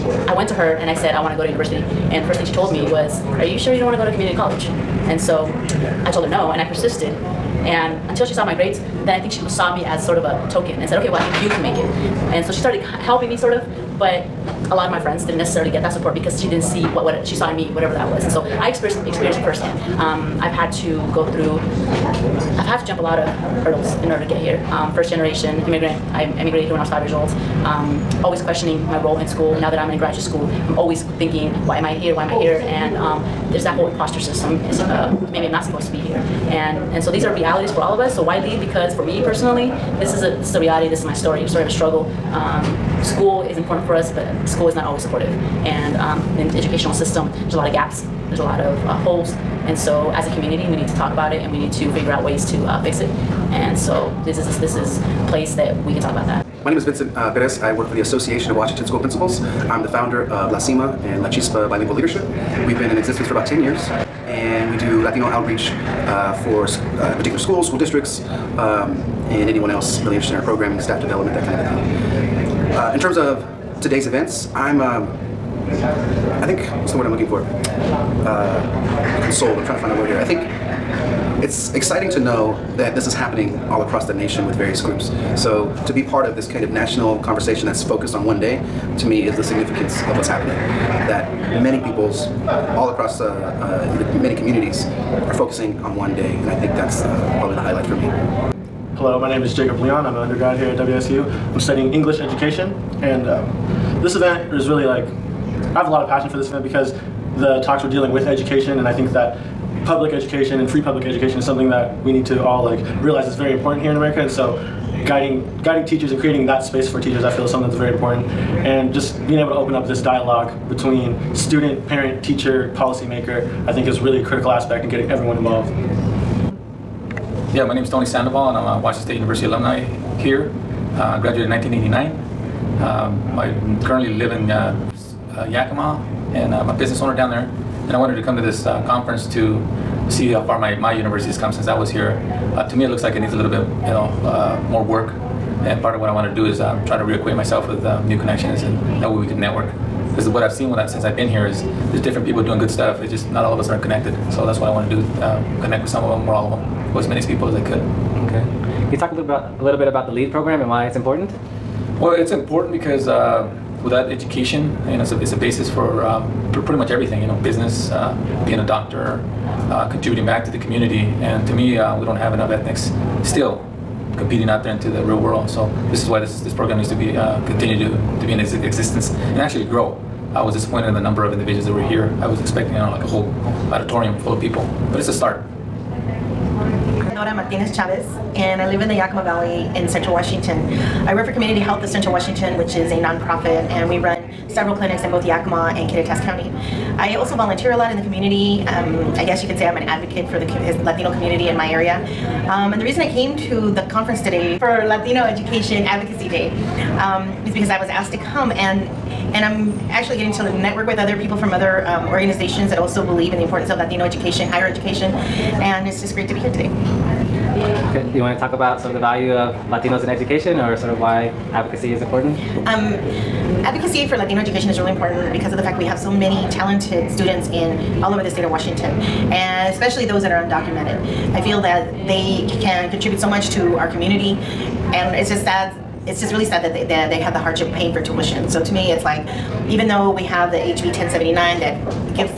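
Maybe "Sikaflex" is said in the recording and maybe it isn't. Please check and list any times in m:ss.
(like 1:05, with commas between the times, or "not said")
not said.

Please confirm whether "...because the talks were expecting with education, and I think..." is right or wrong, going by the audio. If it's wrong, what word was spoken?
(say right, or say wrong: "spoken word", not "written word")
wrong: "dealing", not "expecting".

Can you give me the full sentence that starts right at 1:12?
Uh, in terms of today's events, I'm, um, I think, what's the word I'm looking for?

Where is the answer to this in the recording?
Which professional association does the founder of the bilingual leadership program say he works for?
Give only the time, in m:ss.
0:58.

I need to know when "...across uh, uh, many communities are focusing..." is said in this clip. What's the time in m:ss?
1:32.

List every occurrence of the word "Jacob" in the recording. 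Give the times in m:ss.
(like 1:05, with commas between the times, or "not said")
1:39.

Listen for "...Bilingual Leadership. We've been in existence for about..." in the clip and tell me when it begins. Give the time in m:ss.
1:01.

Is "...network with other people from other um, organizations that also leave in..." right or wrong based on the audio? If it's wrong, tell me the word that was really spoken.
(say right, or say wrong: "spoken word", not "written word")
wrong: "believe", not "leave".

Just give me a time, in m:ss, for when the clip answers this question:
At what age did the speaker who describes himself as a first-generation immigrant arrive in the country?
0:26.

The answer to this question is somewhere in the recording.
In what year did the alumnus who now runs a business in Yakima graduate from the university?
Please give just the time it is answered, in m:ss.
2:11.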